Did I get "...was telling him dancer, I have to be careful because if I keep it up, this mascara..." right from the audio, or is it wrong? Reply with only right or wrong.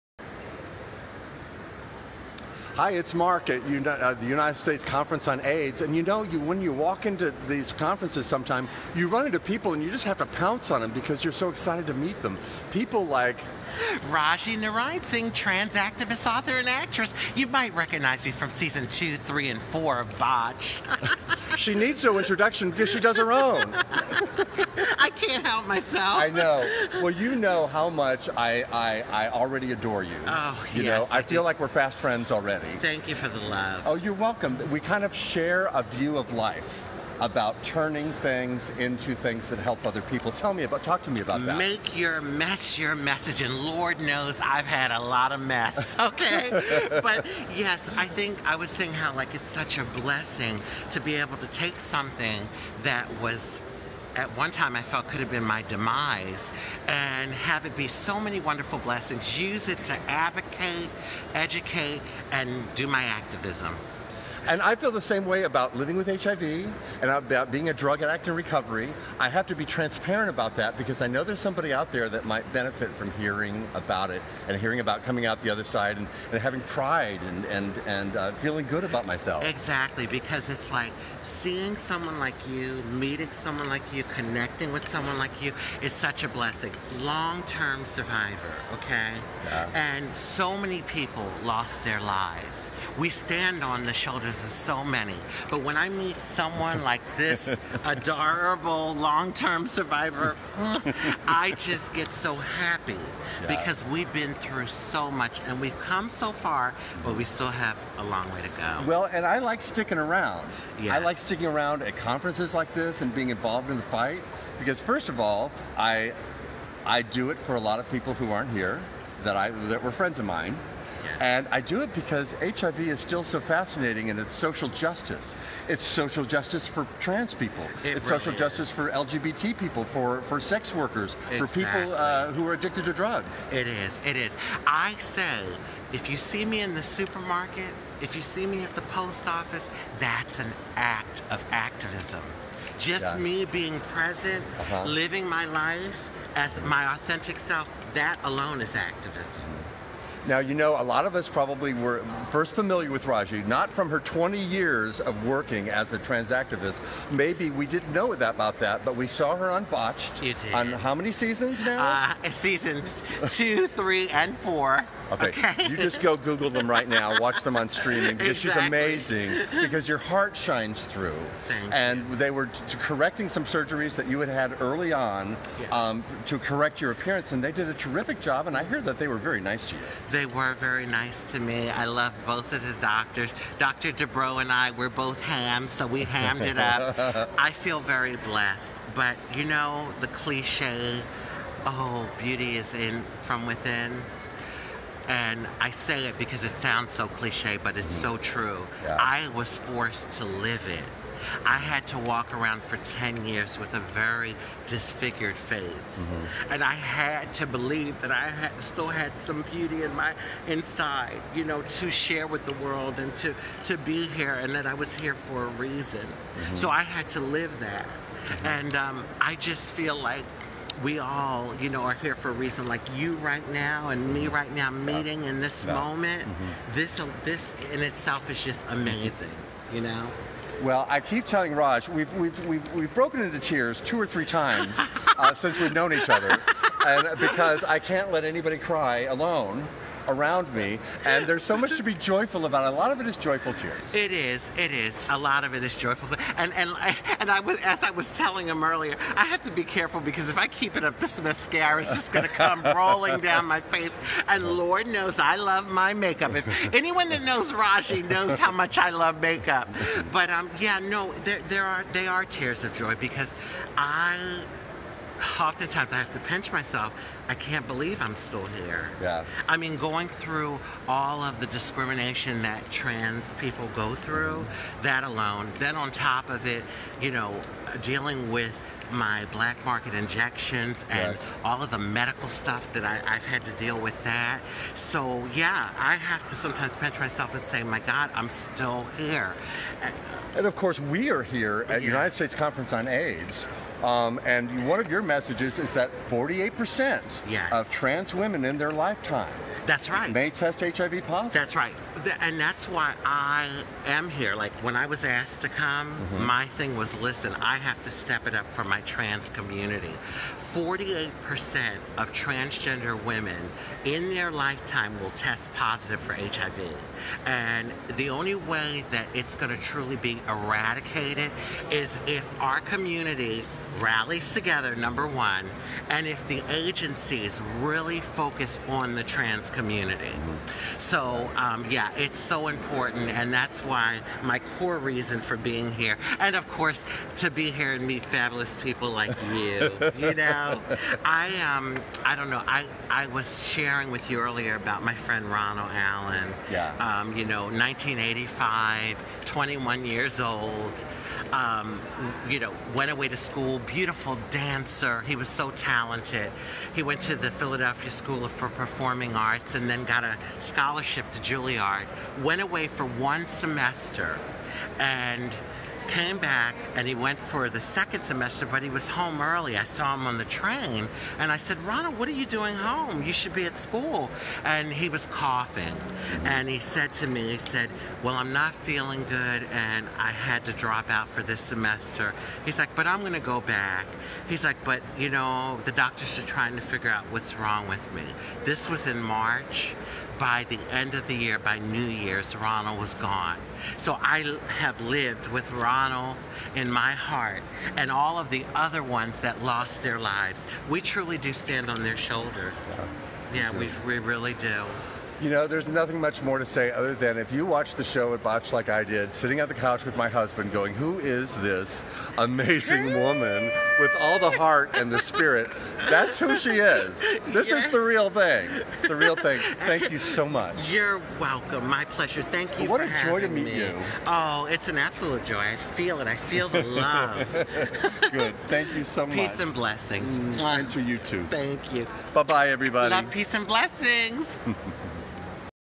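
wrong.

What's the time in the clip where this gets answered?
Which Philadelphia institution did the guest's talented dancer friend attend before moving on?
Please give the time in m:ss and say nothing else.
5:57.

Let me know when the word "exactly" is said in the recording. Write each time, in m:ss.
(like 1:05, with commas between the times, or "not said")
1:19, 2:11, 2:48.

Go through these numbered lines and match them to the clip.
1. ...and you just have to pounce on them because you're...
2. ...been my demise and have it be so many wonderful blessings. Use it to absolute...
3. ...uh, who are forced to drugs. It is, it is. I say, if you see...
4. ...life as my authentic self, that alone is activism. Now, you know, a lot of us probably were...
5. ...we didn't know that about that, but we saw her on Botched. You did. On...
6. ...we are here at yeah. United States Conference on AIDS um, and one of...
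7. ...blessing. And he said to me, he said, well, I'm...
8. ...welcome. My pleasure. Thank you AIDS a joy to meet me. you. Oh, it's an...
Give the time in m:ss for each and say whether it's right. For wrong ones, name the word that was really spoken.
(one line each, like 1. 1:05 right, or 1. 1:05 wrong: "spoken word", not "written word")
1. 0:09 right
2. 0:55 wrong: "advocate", not "absolute"
3. 2:11 wrong: "addicted", not "forced"
4. 2:25 right
5. 2:37 right
6. 4:50 right
7. 6:15 wrong: "coughing", not "blessing"
8. 7:01 wrong: "What", not "AIDS".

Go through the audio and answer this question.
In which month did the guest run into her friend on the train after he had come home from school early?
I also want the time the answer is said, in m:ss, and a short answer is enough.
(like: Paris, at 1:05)
March, at 6:29.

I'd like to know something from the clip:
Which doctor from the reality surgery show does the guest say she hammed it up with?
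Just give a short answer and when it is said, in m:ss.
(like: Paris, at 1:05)
Dr. Dubrow, at 3:03.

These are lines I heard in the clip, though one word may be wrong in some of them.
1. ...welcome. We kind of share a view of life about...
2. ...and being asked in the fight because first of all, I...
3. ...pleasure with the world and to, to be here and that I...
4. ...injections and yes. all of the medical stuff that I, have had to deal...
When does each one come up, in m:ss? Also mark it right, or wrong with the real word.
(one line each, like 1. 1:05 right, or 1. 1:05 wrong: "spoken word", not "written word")
1. 0:34 right
2. 1:53 wrong: "involved", not "asked"
3. 3:31 wrong: "share", not "pleasure"
4. 4:39 right.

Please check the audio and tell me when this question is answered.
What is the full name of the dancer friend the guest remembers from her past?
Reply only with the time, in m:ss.
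5:45.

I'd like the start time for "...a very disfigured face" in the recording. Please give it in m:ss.
3:23.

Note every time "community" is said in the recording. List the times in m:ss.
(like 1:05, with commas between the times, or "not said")
5:09, 5:22, 5:29.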